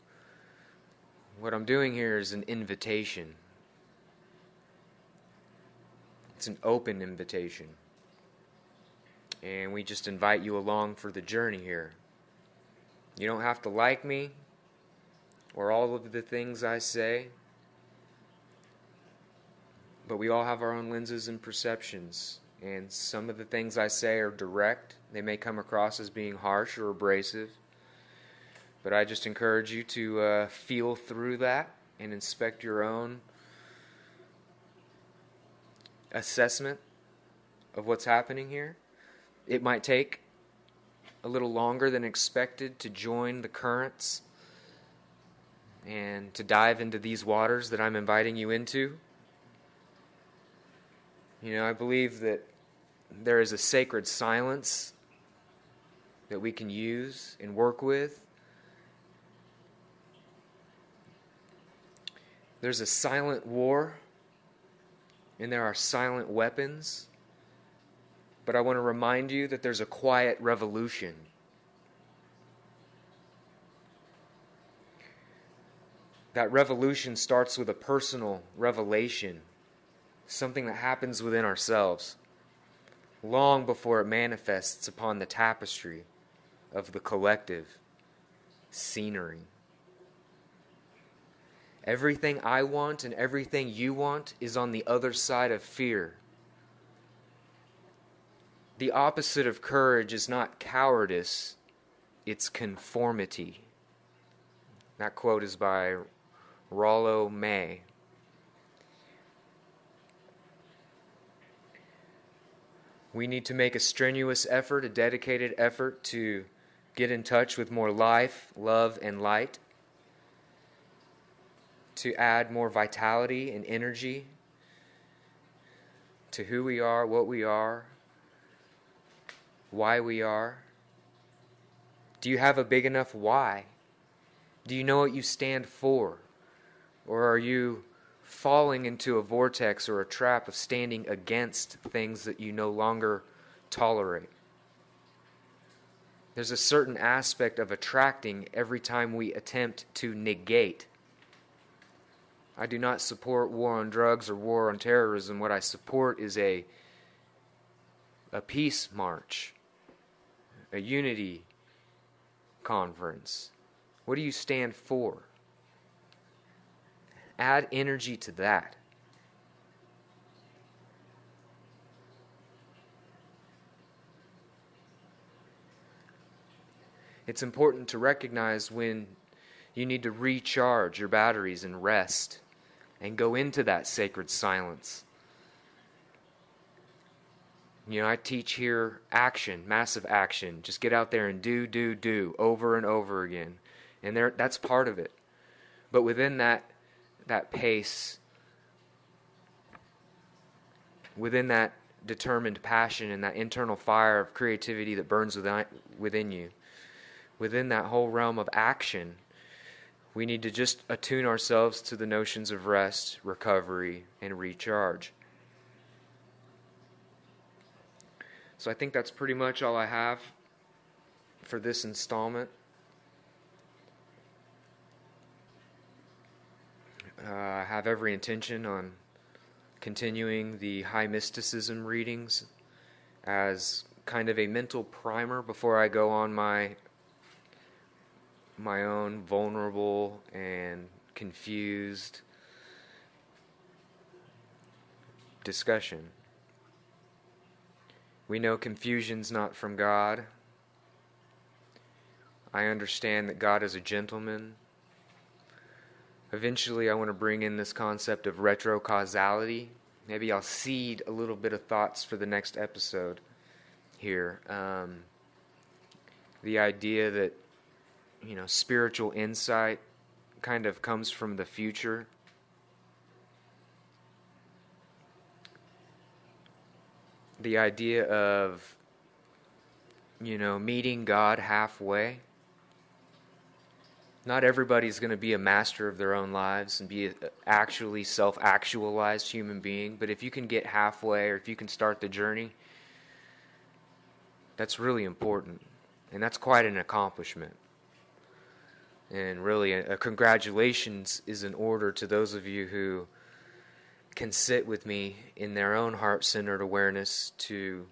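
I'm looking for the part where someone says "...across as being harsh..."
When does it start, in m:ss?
0:25.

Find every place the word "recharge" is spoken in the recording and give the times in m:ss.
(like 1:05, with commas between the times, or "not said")
3:00, 3:34.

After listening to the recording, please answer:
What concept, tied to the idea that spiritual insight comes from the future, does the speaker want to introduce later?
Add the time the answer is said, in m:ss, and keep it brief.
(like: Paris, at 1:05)
Retrocausality, at 4:18.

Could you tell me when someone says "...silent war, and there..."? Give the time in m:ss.
1:02.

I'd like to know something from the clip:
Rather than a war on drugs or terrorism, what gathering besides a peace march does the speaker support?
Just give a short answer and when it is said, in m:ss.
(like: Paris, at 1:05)
A unity conference, at 2:40.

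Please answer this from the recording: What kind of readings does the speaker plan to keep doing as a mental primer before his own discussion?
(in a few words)
High mysticism.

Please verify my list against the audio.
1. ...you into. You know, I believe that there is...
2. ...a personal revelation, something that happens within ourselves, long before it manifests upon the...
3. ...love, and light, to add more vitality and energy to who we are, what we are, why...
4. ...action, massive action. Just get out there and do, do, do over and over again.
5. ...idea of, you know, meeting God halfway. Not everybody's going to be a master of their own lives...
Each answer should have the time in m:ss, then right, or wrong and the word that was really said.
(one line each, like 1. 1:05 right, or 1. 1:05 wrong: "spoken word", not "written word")
1. 0:48 right
2. 1:17 right
3. 1:58 right
4. 3:09 right
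5. 4:37 right.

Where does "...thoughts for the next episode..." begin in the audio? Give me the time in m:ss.
4:21.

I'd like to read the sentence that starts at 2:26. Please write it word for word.
There's a certain aspect of attracting every time we attempt to negate.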